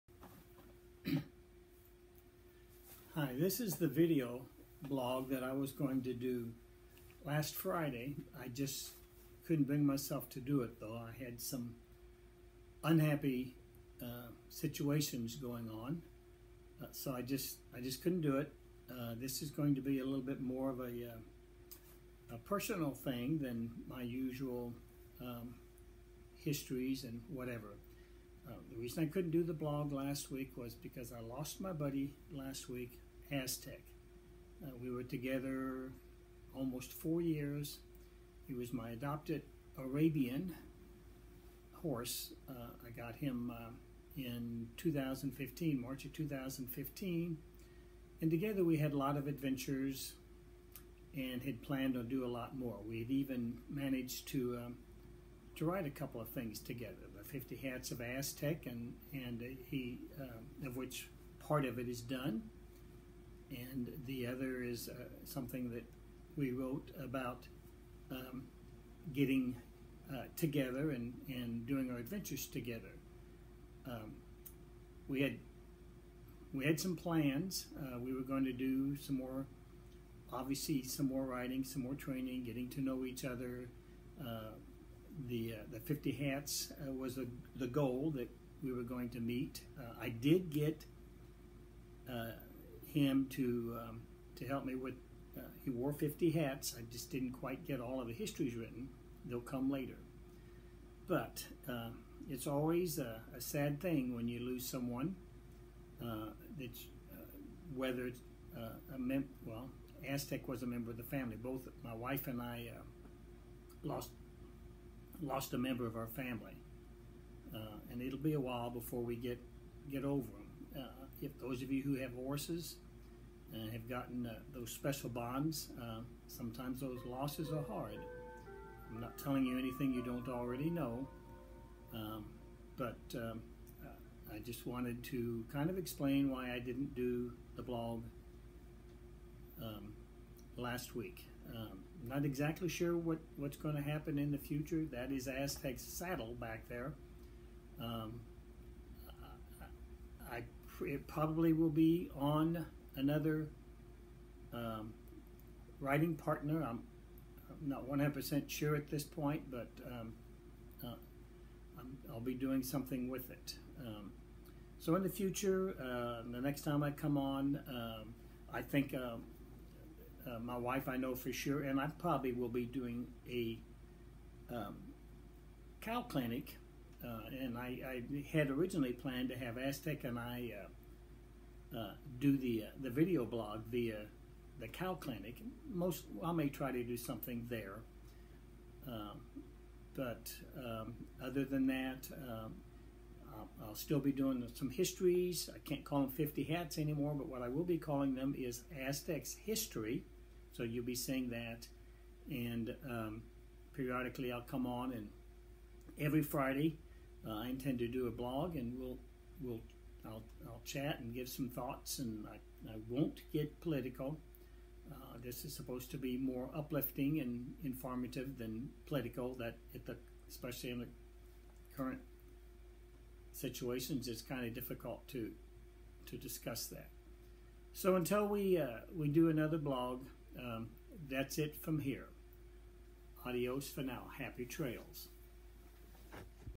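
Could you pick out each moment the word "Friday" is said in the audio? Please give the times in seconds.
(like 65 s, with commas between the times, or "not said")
7 s, 206 s.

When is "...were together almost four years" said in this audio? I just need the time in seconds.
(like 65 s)
34 s.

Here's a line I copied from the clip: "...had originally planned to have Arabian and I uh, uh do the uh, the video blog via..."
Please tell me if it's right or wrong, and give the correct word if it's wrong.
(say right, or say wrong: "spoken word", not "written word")
wrong: "Aztec", not "Arabian".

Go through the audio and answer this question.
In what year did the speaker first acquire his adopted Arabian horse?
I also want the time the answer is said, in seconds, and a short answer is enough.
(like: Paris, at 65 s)
2015, at 45 s.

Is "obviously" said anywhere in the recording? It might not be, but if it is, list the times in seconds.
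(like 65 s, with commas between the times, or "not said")
80 s.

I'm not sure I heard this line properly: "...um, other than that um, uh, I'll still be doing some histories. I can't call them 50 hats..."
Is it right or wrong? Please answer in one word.
right.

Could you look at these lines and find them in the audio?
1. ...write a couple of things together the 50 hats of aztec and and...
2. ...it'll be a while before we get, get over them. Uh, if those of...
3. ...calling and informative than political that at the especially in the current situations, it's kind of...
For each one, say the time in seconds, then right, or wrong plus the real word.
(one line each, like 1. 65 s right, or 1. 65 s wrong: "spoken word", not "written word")
1. 55 s right
2. 118 s right
3. 216 s wrong: "uplifting", not "calling".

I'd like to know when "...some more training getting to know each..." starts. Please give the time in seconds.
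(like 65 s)
81 s.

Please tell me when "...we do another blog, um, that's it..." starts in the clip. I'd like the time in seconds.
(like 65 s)
228 s.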